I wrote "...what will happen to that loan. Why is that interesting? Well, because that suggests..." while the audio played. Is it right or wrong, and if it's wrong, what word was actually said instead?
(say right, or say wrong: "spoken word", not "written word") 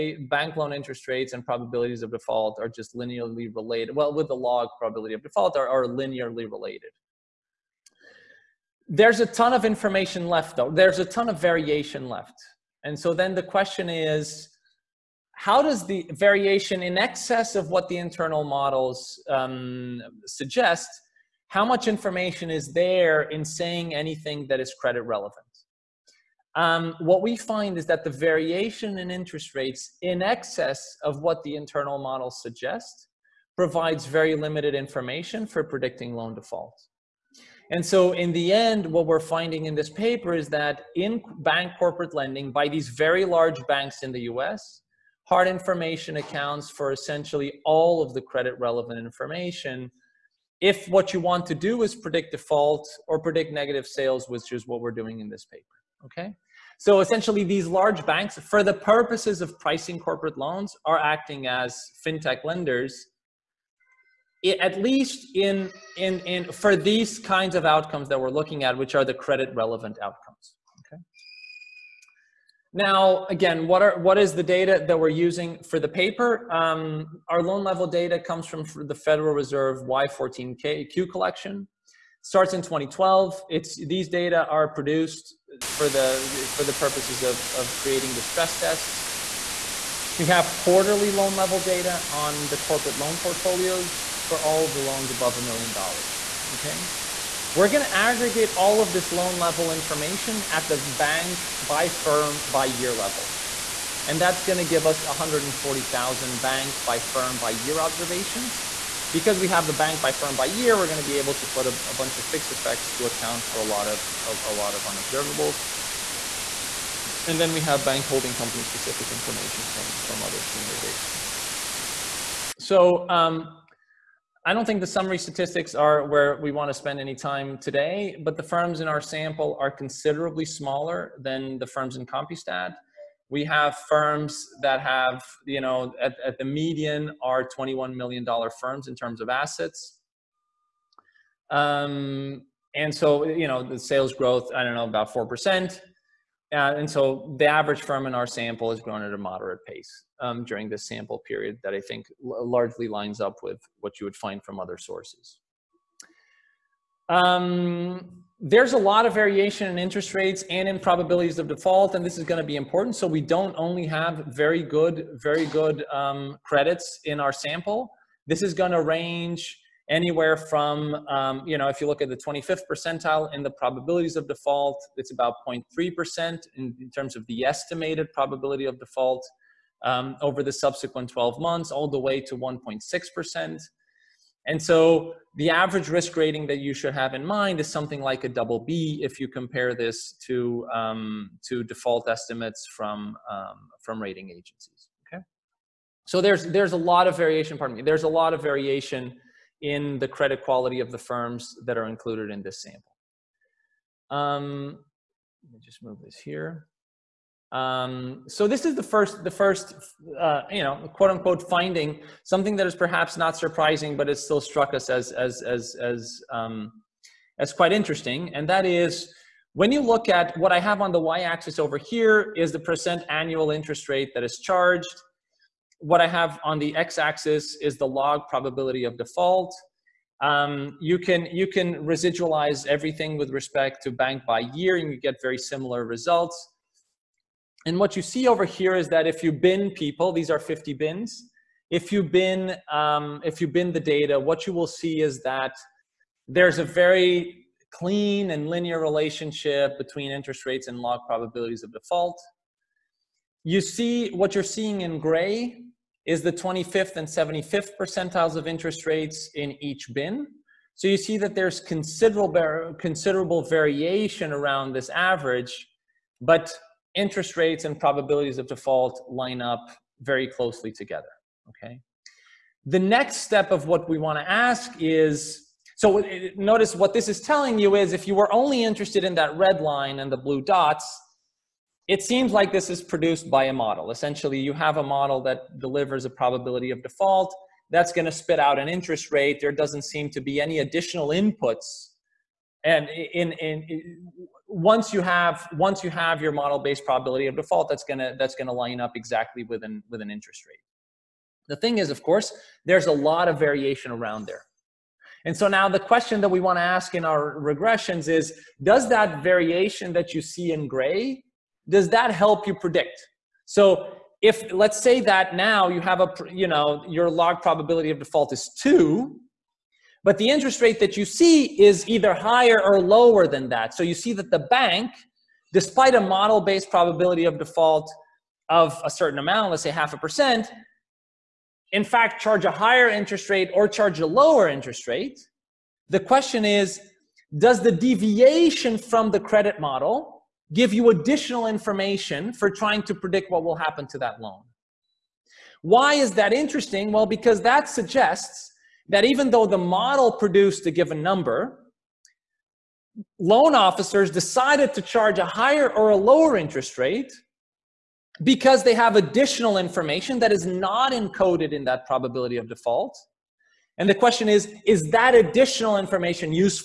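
right.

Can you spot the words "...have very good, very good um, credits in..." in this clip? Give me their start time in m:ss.
2:43.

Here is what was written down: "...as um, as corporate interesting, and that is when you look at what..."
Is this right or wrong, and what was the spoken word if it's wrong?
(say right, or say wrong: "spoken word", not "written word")
wrong: "quite", not "corporate".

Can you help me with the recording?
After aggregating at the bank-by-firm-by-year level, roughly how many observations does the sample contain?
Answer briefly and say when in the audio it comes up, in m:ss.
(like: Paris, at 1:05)
140,000, at 1:45.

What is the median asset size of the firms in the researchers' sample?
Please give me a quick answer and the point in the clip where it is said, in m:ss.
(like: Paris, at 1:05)
$21 million, at 2:17.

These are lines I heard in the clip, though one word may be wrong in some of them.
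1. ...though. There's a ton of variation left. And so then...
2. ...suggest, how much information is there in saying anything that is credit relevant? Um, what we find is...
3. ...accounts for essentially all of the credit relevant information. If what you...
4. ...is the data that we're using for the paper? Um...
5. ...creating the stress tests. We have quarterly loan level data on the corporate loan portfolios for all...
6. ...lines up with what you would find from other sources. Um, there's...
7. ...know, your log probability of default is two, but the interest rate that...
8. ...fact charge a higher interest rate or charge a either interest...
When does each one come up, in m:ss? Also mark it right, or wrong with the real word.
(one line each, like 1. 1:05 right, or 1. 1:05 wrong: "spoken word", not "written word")
1. 0:10 right
2. 0:20 right
3. 0:46 right
4. 1:14 right
5. 1:27 right
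6. 2:32 right
7. 5:16 right
8. 5:31 wrong: "lower", not "either".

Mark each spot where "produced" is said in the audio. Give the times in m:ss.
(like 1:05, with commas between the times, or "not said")
1:24, 4:42, 5:50.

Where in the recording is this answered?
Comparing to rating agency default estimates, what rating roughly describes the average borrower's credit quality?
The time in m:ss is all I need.
3:08.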